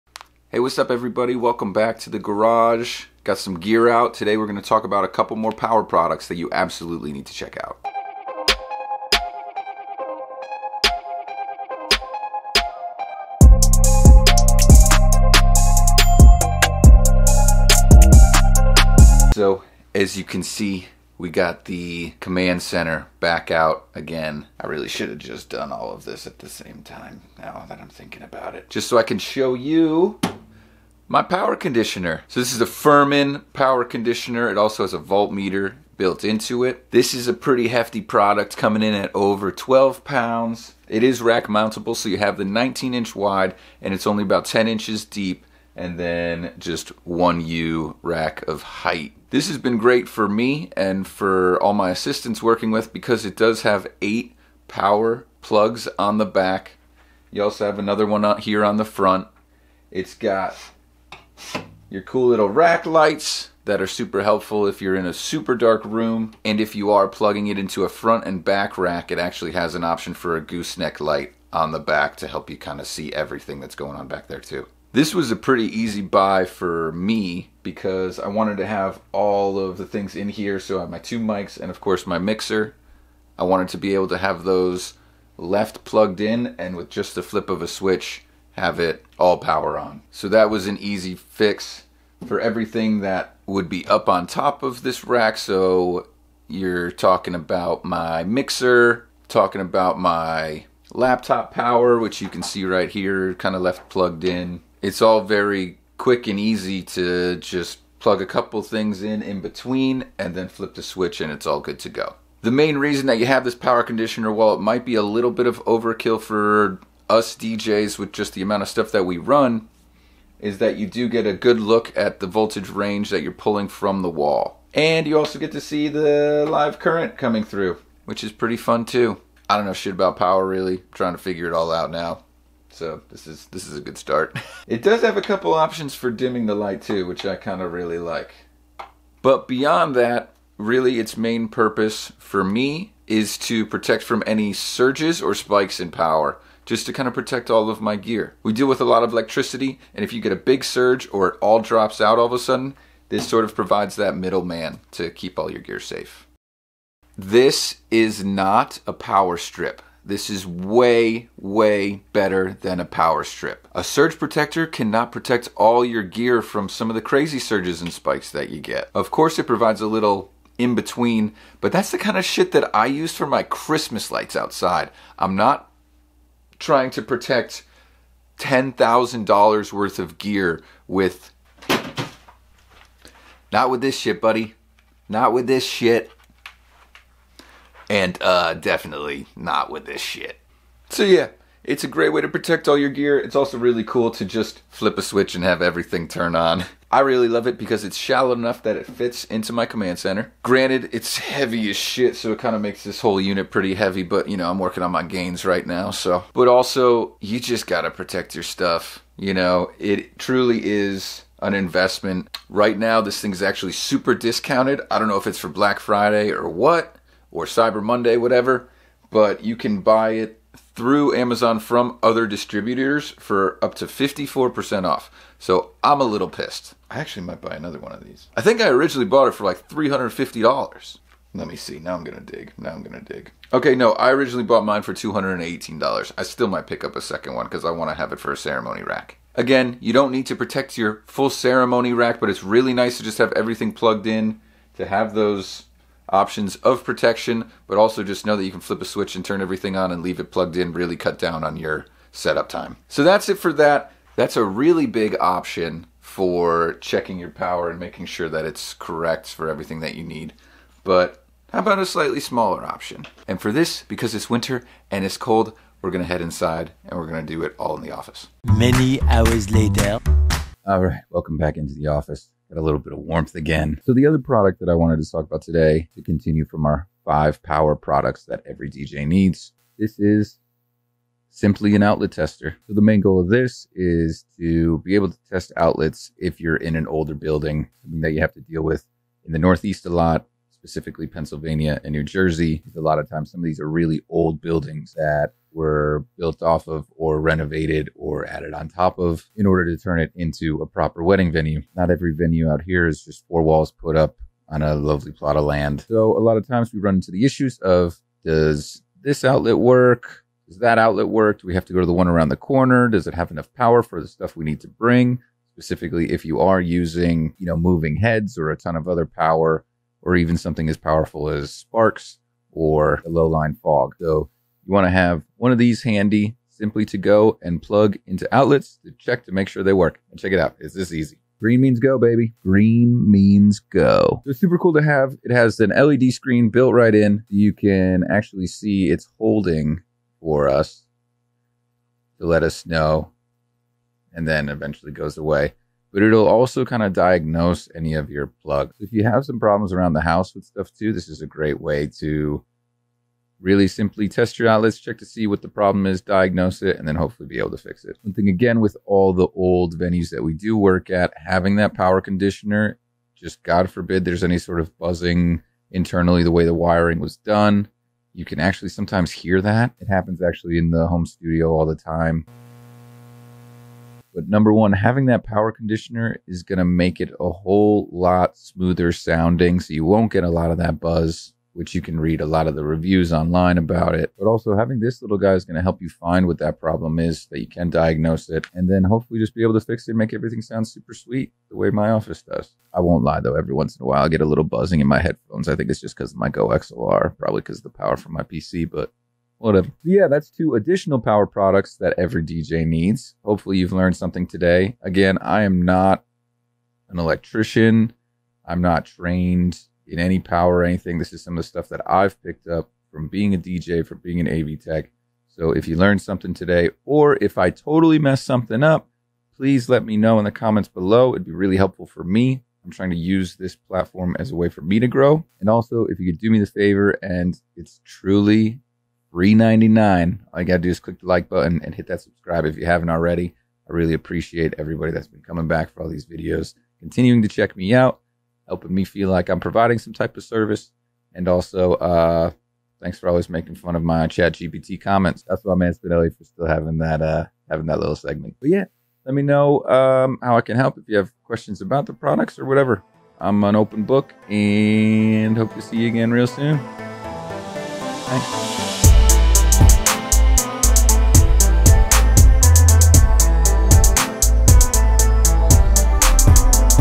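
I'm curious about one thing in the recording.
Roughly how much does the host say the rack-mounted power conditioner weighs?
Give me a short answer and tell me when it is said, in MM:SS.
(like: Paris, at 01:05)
over 12 pounds, at 00:39.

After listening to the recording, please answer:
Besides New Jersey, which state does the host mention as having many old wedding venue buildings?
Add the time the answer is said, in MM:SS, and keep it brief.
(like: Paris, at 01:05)
Pennsylvania, at 04:51.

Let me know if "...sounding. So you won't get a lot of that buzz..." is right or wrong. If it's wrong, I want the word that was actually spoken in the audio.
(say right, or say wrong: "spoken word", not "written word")
right.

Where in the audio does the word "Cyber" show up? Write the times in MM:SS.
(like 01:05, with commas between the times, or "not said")
03:37.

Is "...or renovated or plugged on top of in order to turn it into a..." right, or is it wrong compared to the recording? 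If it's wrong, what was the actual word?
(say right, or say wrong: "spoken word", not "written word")
wrong: "added", not "plugged".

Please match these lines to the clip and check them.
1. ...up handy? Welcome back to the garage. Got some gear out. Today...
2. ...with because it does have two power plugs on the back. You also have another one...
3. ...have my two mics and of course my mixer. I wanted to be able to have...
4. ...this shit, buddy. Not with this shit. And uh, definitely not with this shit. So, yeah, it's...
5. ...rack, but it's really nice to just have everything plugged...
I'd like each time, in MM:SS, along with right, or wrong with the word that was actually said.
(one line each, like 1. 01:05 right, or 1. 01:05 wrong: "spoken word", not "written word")
1. 00:00 wrong: "everybody", not "handy"
2. 00:52 wrong: "eight", not "two"
3. 01:20 right
4. 03:03 right
5. 04:01 right.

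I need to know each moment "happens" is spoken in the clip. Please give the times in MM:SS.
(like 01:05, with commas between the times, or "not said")
06:09.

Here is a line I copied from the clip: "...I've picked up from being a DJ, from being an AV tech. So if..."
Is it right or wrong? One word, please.
right.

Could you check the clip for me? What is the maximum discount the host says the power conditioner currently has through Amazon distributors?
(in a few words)
54%.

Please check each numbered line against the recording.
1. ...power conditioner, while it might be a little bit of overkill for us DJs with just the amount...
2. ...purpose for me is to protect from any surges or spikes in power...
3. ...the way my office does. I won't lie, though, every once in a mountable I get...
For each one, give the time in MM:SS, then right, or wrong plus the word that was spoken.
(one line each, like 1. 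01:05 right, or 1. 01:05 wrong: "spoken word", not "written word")
1. 01:53 right
2. 02:21 right
3. 06:31 wrong: "while", not "mountable".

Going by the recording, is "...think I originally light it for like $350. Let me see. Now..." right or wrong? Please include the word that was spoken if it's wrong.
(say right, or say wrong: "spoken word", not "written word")
wrong: "bought", not "light".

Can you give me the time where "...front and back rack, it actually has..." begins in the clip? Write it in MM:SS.
01:07.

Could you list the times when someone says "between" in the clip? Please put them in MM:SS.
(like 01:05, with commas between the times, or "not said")
01:49, 02:50.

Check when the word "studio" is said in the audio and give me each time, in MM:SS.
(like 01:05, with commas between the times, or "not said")
06:11.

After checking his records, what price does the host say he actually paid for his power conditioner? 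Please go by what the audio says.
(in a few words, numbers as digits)
$218.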